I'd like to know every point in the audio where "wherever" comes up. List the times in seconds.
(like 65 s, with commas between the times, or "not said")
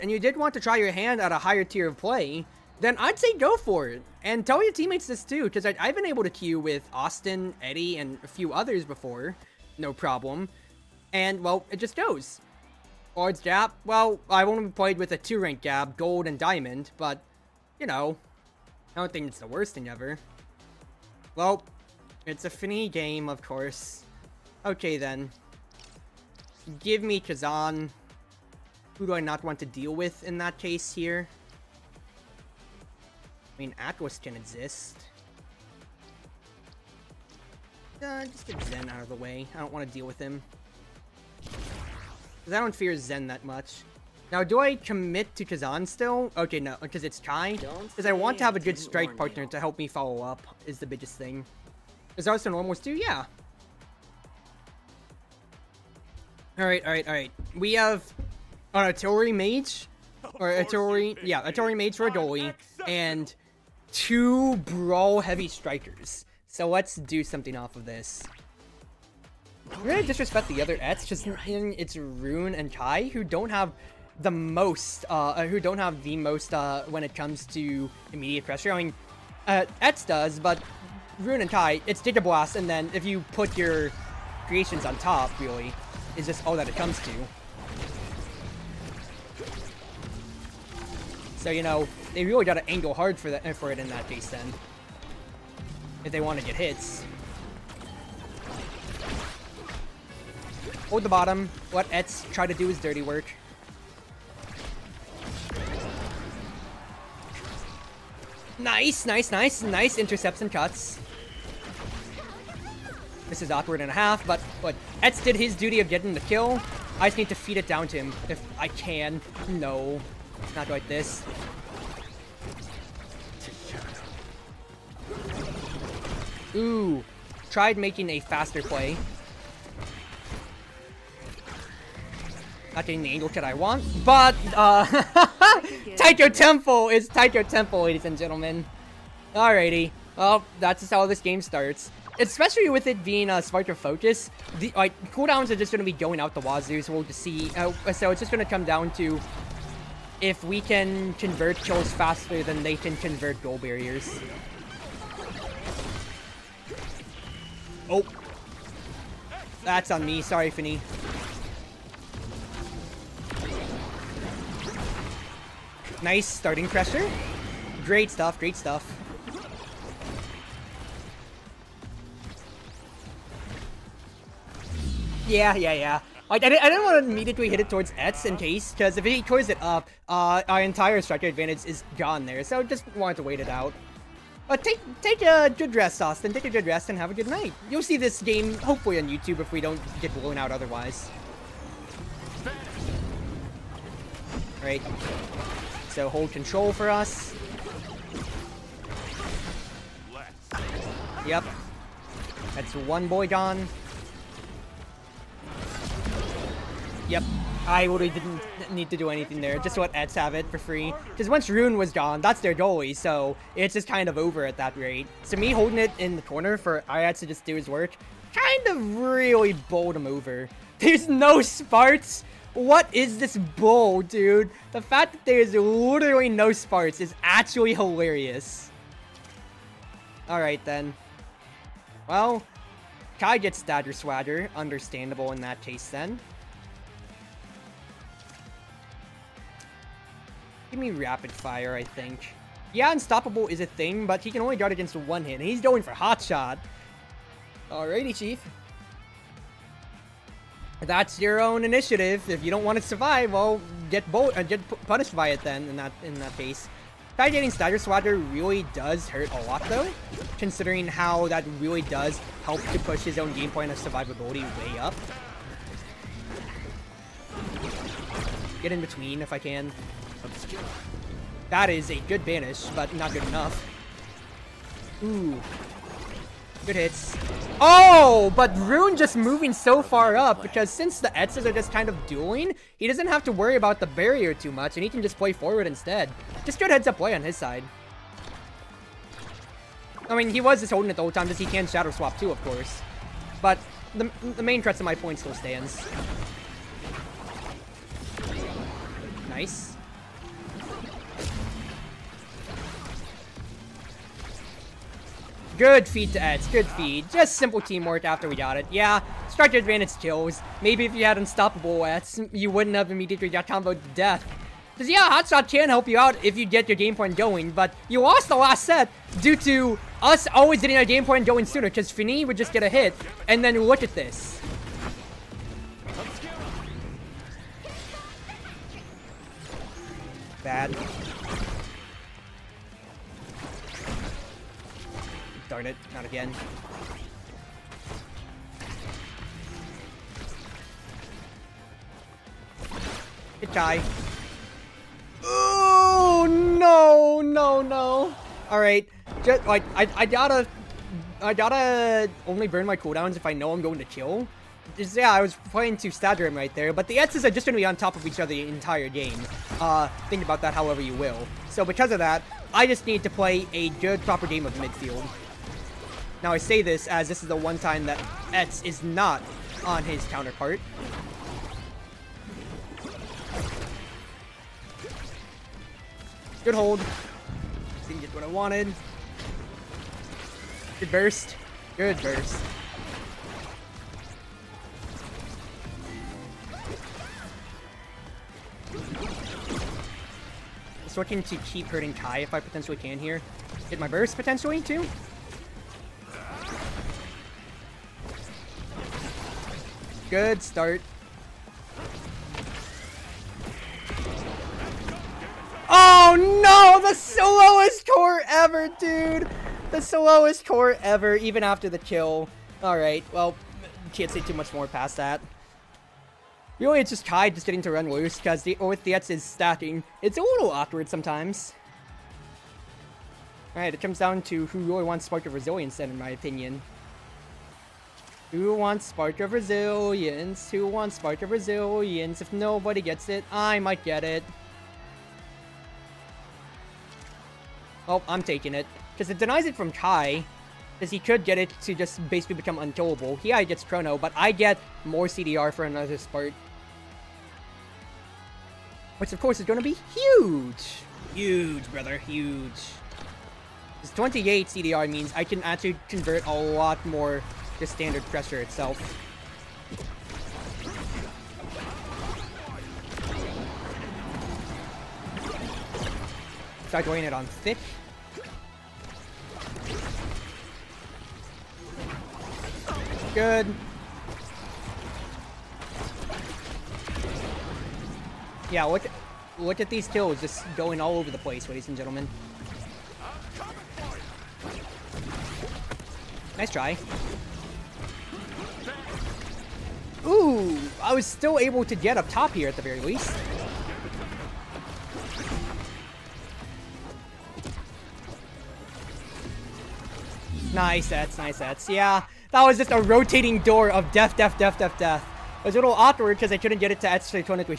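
not said.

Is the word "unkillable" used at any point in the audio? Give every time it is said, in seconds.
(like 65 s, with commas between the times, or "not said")
442 s.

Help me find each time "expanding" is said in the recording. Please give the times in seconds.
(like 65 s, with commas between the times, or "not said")
not said.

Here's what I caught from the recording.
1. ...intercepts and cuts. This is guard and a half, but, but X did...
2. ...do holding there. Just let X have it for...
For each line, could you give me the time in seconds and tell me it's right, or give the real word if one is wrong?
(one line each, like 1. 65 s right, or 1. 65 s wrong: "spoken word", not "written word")
1. 109 s wrong: "awkward", not "guard"
2. 208 s wrong: "anything", not "holding".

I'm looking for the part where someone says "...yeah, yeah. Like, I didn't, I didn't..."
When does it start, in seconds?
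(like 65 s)
175 s.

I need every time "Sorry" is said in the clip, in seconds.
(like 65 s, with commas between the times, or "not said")
160 s.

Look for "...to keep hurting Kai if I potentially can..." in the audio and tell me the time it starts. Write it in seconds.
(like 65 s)
391 s.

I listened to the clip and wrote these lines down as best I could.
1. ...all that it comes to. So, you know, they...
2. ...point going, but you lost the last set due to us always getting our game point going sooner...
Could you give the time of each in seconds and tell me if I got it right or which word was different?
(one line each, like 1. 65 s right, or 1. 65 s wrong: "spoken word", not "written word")
1. 86 s right
2. 316 s right.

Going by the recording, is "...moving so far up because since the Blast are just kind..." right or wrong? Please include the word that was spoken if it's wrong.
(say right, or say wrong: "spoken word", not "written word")
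wrong: "Etzes", not "Blast".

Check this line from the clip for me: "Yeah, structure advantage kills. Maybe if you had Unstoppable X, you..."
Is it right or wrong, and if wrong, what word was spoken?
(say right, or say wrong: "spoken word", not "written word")
right.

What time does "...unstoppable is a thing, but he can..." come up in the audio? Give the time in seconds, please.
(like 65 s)
242 s.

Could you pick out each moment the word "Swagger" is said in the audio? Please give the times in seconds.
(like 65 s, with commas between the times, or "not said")
233 s, 257 s.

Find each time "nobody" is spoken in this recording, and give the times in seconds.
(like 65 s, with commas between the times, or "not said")
432 s.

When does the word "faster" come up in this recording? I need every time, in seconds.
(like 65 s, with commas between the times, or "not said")
128 s, 151 s.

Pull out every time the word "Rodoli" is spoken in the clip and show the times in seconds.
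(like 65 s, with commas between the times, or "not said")
61 s.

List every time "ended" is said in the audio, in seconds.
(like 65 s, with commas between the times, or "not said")
not said.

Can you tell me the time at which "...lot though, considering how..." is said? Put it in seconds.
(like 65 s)
259 s.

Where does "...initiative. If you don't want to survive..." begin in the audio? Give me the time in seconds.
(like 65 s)
251 s.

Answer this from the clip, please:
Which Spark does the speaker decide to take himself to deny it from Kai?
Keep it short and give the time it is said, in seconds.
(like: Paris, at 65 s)
Spark of Resilience, at 425 s.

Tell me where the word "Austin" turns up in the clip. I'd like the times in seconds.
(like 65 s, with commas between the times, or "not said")
6 s, 186 s.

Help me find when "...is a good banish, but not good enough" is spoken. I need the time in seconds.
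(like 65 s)
271 s.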